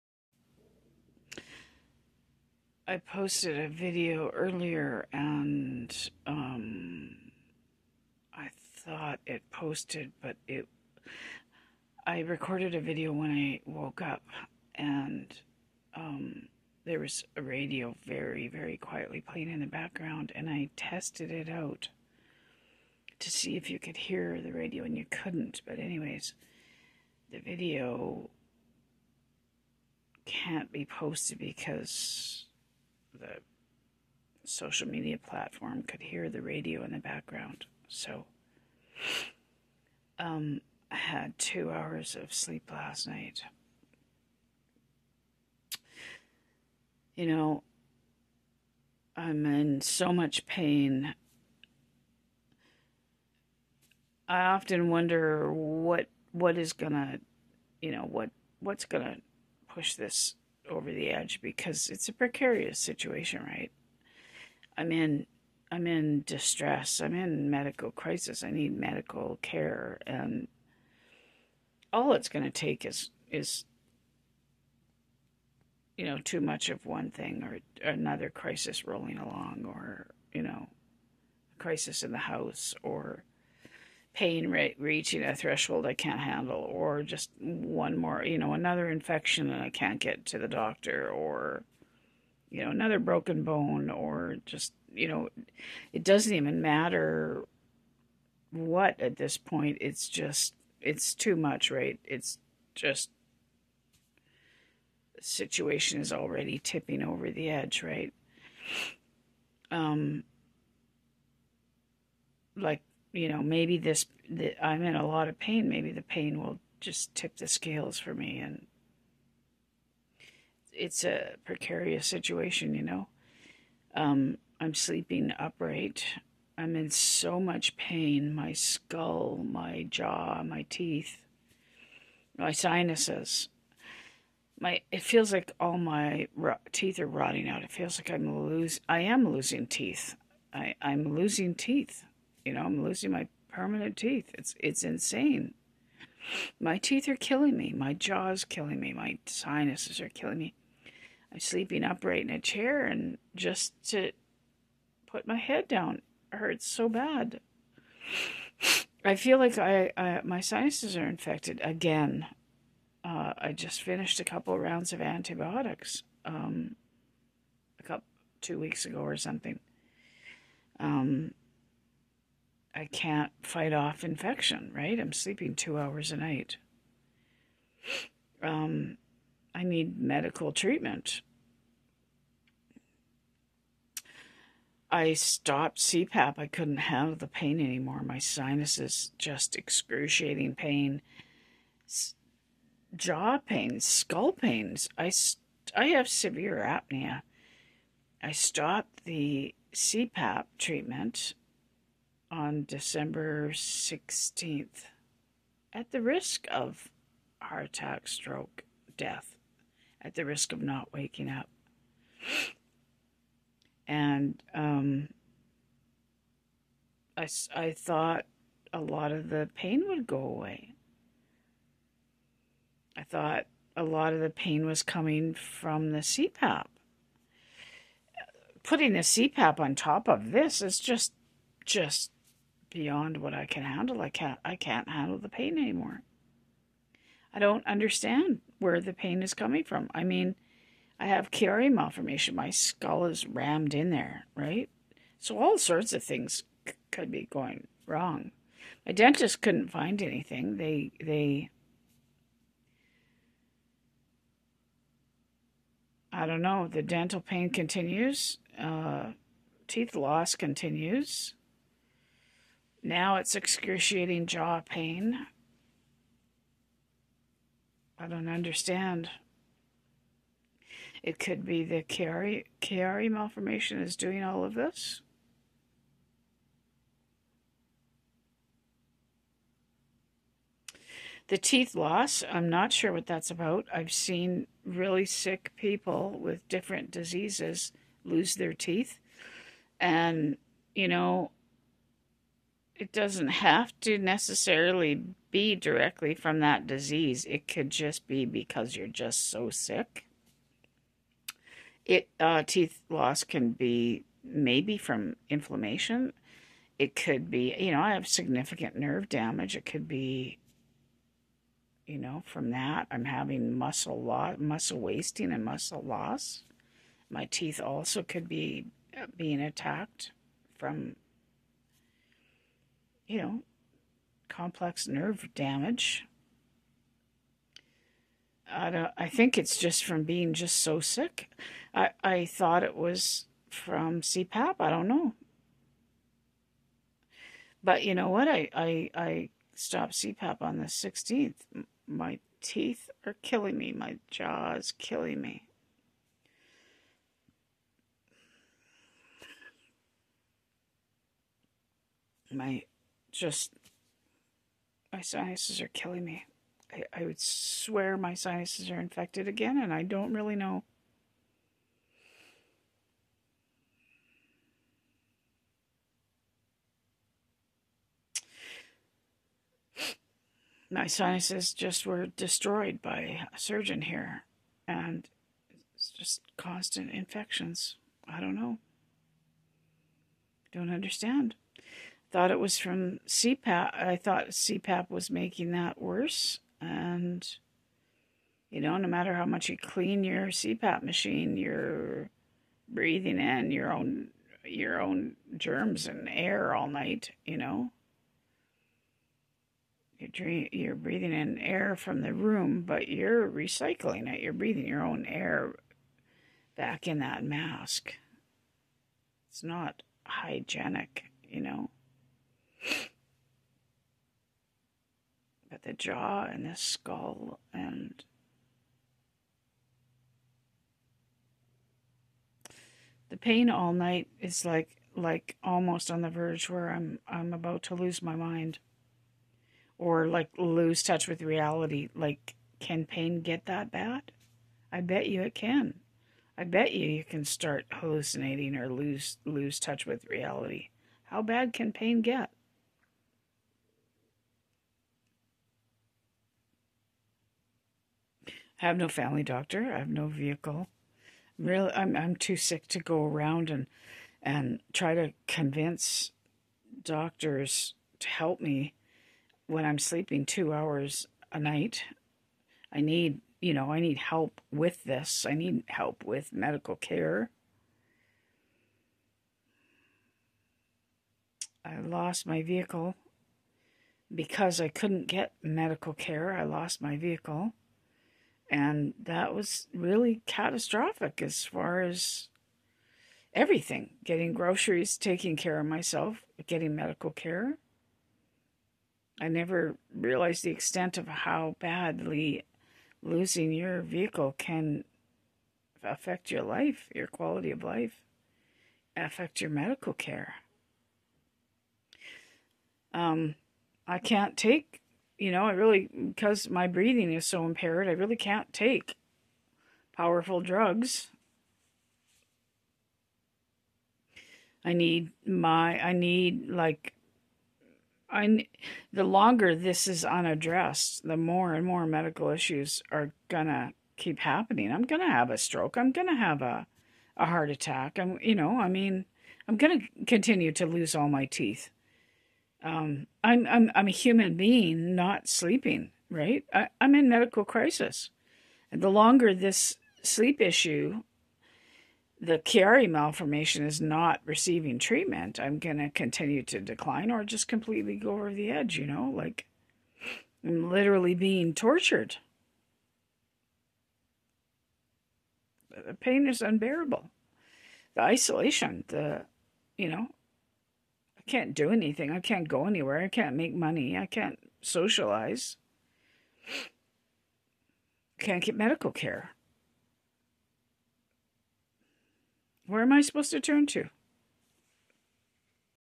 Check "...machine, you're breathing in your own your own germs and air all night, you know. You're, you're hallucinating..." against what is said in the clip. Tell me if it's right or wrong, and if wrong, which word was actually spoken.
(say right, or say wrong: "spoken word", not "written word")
wrong: "breathing", not "hallucinating".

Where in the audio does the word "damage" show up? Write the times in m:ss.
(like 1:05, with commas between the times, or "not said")
5:09, 5:25.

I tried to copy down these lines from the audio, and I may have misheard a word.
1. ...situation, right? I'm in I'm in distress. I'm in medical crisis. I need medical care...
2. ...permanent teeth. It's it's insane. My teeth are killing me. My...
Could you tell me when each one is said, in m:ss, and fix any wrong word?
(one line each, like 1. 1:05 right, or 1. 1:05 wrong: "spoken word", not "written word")
1. 1:02 right
2. 2:23 right.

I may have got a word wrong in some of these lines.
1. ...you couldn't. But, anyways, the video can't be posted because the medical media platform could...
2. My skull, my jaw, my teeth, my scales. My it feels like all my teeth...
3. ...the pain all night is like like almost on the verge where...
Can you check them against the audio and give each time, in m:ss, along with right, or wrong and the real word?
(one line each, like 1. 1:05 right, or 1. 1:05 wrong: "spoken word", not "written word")
1. 0:24 wrong: "social", not "medical"
2. 2:08 wrong: "sinuses", not "scales"
3. 7:03 right.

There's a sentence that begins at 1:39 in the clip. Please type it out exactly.
It's just, it's too much, right?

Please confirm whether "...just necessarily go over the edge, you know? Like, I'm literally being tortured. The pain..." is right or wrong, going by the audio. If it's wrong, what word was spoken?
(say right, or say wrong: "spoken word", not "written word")
wrong: "completely", not "necessarily".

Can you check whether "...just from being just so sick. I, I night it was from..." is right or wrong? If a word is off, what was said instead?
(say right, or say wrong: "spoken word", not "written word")
wrong: "thought", not "night".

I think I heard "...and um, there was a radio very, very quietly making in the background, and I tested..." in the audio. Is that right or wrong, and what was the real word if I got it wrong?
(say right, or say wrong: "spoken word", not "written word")
wrong: "playing", not "making".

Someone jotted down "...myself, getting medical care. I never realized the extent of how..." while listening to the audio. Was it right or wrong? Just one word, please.
right.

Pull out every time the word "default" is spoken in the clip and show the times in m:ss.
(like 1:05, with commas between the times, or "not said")
not said.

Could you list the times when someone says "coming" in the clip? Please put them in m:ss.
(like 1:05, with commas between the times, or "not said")
3:44, 3:59.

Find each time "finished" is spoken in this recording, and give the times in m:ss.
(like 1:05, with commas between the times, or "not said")
2:43.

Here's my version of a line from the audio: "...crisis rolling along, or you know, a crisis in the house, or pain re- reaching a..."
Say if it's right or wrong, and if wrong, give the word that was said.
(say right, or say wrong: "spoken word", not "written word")
right.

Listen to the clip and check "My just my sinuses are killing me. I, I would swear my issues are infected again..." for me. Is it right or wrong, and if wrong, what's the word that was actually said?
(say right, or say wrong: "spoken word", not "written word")
wrong: "sinuses", not "issues".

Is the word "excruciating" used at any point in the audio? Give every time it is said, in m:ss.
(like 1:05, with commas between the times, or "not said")
3:09, 4:23.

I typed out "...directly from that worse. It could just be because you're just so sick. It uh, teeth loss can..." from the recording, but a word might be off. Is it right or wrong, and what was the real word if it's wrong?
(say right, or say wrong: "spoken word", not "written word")
wrong: "disease", not "worse".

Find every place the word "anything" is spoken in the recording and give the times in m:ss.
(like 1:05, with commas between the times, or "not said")
4:10, 9:21.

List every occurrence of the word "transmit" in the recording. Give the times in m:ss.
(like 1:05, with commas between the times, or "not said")
not said.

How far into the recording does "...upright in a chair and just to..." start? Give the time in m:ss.
2:31.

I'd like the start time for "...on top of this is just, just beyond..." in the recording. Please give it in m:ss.
3:49.